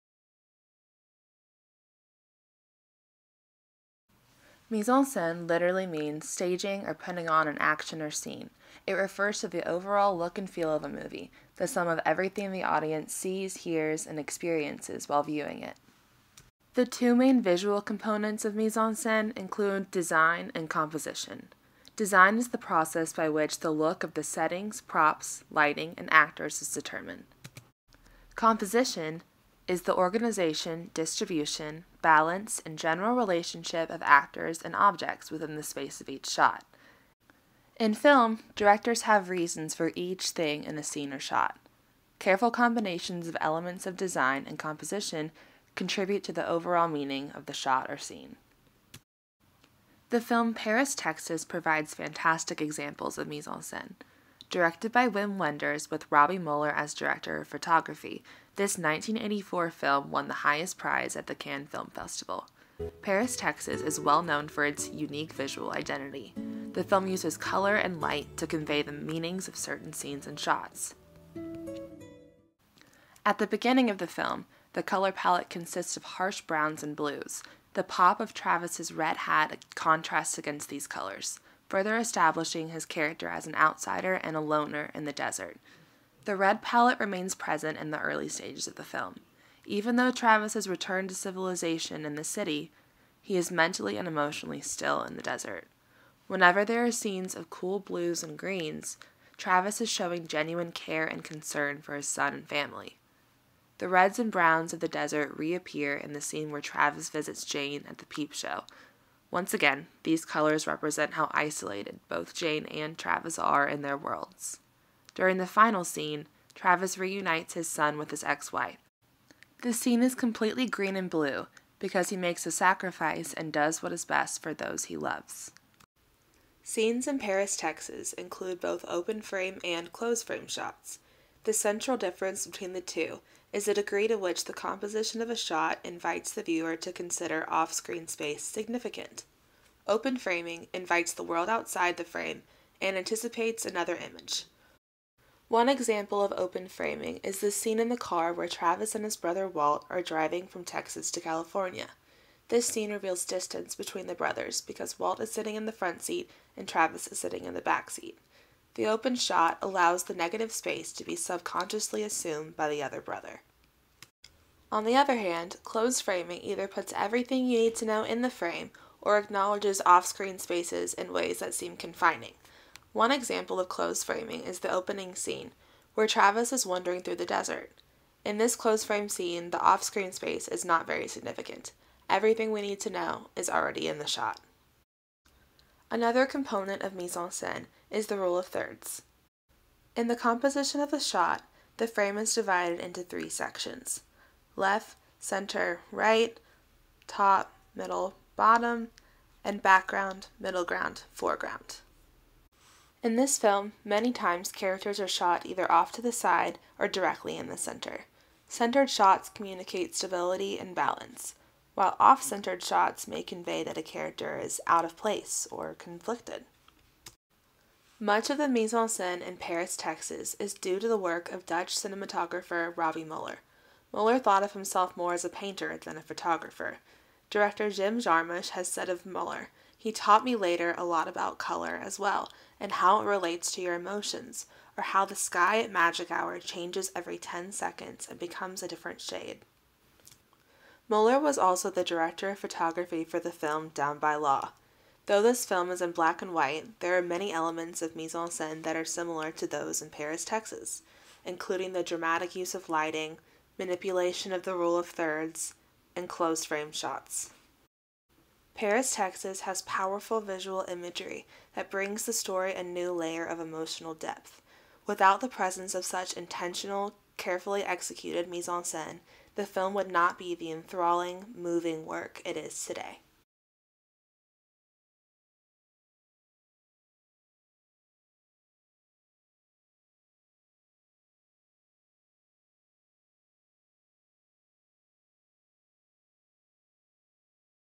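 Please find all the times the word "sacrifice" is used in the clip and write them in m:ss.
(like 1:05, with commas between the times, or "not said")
2:02.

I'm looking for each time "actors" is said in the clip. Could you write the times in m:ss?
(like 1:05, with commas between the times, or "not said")
0:26, 0:34.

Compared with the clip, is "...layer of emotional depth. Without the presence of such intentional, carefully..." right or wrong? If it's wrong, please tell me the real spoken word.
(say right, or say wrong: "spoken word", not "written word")
right.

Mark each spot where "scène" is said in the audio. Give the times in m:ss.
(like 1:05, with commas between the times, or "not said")
0:05, 0:18, 0:53, 3:06, 3:38, 4:08, 4:28.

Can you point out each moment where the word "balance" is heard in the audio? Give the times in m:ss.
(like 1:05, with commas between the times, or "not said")
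0:32, 3:30.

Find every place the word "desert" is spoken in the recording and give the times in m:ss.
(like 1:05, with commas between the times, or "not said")
1:25, 1:35, 1:44, 2:57.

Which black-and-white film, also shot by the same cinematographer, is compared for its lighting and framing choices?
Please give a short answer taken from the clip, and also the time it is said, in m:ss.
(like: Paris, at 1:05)
Down by Law, at 4:03.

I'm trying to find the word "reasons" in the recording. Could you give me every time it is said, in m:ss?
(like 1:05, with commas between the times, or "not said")
0:39.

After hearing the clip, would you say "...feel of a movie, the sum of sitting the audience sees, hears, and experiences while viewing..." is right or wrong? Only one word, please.
wrong.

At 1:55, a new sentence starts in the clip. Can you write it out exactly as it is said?
During the final scene, Travis reunites his son with his ex wife.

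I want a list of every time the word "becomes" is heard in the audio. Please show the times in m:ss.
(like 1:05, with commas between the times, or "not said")
3:58.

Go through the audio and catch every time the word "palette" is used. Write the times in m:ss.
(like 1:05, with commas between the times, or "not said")
1:15, 1:26.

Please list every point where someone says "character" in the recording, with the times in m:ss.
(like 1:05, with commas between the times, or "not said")
1:22, 3:24, 3:33.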